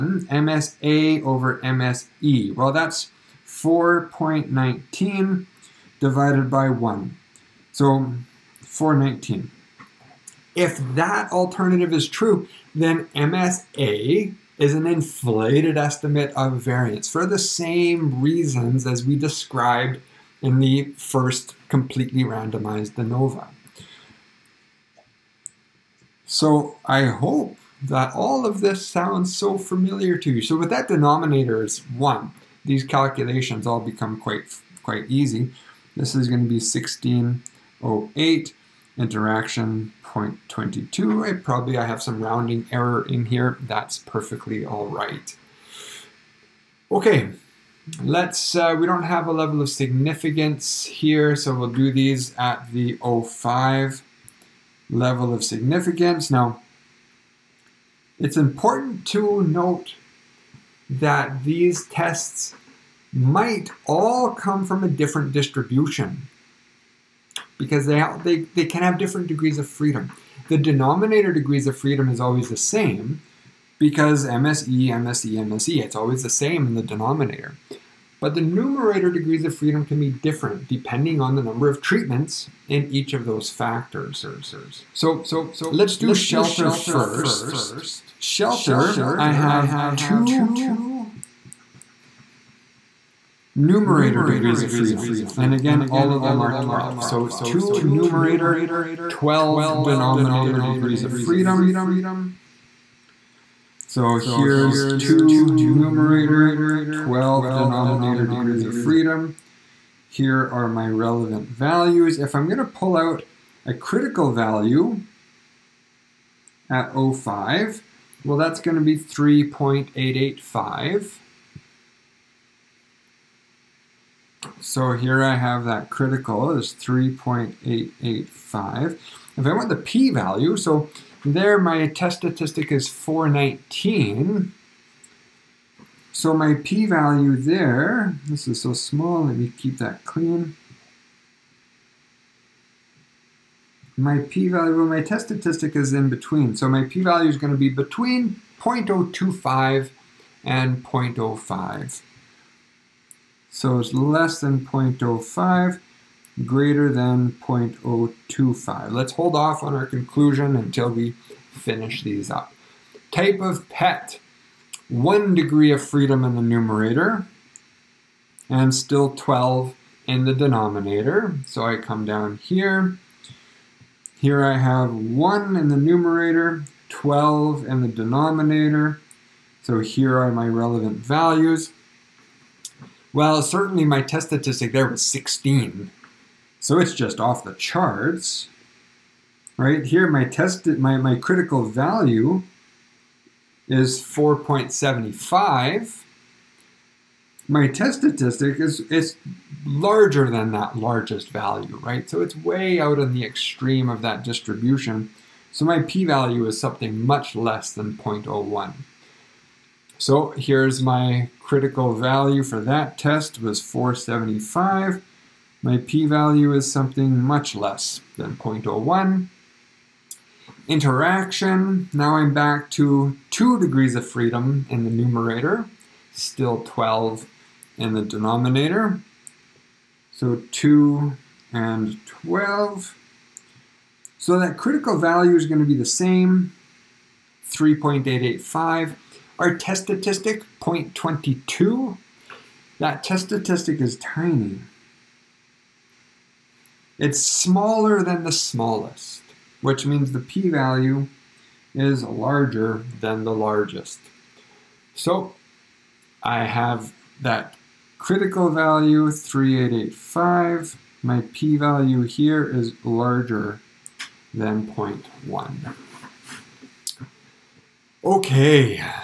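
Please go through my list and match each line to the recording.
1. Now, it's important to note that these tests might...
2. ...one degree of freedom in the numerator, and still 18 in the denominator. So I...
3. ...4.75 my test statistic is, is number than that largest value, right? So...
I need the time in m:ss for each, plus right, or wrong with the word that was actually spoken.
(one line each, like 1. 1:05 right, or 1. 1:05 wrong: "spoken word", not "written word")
1. 0:56 right
2. 2:44 wrong: "12", not "18"
3. 3:14 wrong: "larger", not "number".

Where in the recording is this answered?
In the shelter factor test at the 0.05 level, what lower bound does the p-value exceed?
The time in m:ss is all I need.
2:36.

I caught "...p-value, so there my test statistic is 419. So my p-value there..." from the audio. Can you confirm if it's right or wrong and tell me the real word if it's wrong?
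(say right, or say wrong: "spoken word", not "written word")
right.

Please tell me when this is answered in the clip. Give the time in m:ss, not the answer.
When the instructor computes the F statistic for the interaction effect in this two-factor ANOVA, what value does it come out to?
0:38.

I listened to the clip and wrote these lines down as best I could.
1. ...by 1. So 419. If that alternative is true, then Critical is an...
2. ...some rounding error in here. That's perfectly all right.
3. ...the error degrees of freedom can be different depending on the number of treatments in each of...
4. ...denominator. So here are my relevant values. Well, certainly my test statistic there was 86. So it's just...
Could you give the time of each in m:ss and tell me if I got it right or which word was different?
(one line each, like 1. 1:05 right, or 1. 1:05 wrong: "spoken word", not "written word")
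1. 0:06 wrong: "MSA", not "Critical"
2. 0:42 right
3. 1:18 wrong: "numerator", not "error"
4. 2:57 wrong: "16", not "86".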